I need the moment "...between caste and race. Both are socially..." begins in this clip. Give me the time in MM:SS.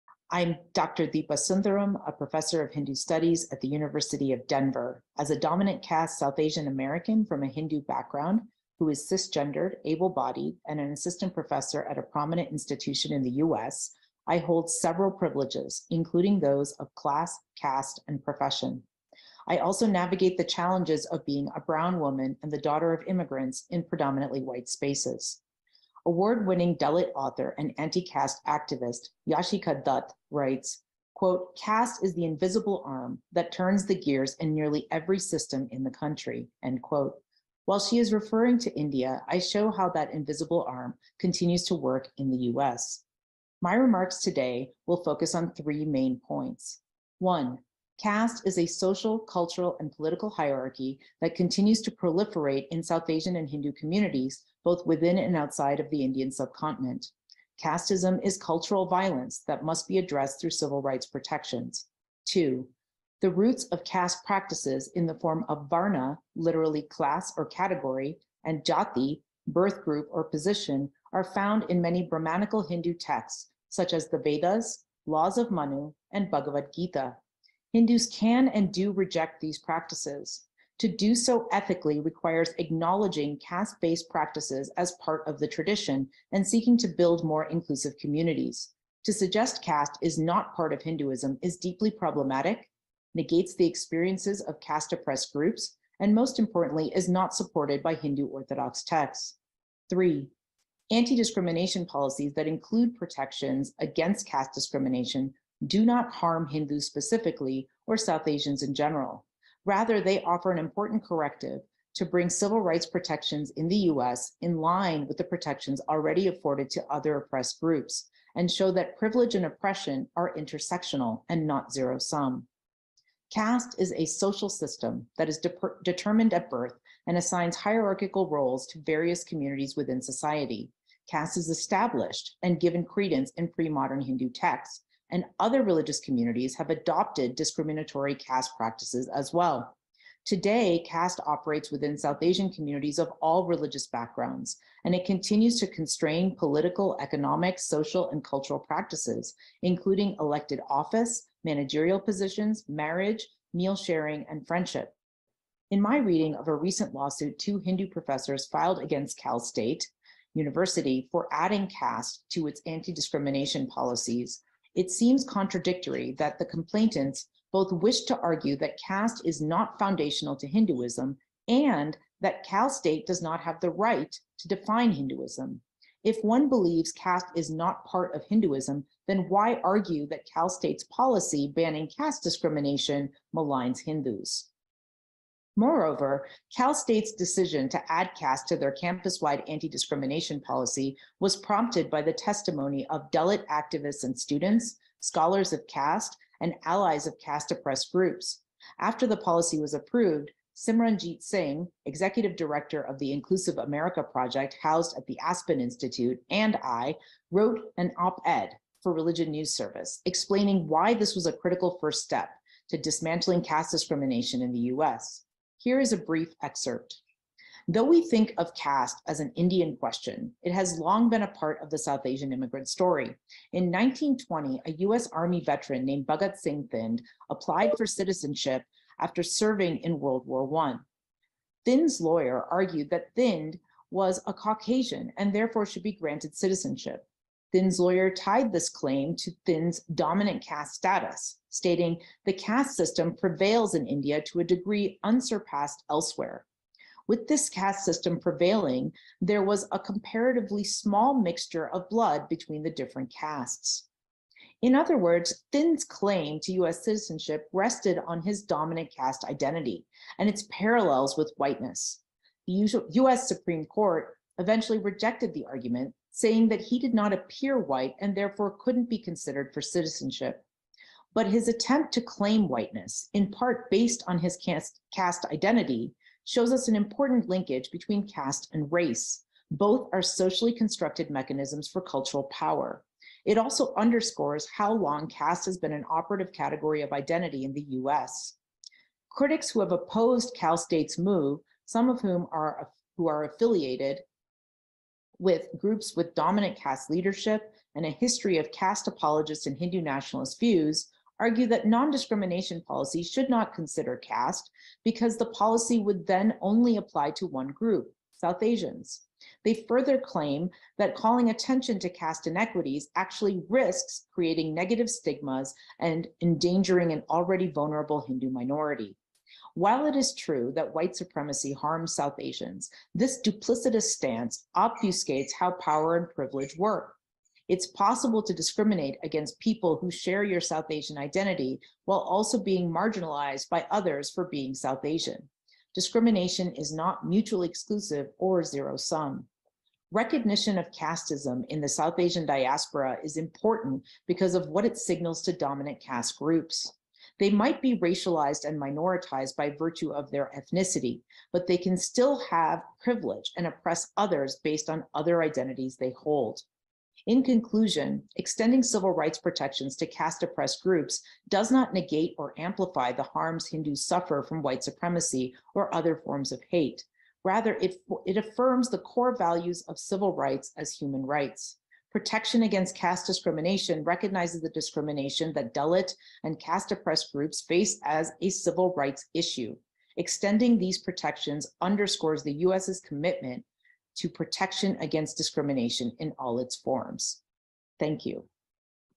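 04:37.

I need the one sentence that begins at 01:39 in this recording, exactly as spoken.
Three, anti-discrimination policies that include protections against caste discrimination do not harm Hindus specifically or South Asians in general.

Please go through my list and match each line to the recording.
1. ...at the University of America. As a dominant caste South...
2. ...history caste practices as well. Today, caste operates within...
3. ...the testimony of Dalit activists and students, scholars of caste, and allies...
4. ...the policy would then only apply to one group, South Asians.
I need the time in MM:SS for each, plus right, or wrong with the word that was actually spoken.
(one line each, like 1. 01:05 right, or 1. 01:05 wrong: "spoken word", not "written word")
1. 00:03 wrong: "Denver", not "America"
2. 02:17 wrong: "discriminatory", not "history"
3. 03:12 right
4. 05:05 right.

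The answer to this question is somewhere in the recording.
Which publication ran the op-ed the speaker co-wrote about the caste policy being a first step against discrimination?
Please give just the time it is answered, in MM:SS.
03:28.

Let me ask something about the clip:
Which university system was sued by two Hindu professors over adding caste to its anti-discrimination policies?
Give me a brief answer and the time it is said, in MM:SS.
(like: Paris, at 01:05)
Cal State University, at 02:39.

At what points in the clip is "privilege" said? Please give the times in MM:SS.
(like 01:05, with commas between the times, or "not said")
00:15, 01:58, 05:26, 05:52.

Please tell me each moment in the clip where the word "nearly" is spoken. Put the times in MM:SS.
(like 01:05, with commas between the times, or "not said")
00:34.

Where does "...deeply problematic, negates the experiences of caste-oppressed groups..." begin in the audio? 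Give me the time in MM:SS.
01:31.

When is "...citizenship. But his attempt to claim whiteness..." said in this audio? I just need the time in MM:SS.
04:29.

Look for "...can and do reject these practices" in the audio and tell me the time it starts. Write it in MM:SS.
01:18.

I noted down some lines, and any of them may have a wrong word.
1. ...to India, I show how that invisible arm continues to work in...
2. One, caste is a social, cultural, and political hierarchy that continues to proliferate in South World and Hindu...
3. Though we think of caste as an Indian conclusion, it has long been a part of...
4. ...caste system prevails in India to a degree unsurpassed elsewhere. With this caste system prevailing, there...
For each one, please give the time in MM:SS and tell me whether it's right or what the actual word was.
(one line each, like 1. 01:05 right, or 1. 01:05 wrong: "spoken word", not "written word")
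1. 00:38 right
2. 00:47 wrong: "Asian", not "World"
3. 03:37 wrong: "question", not "conclusion"
4. 04:02 right.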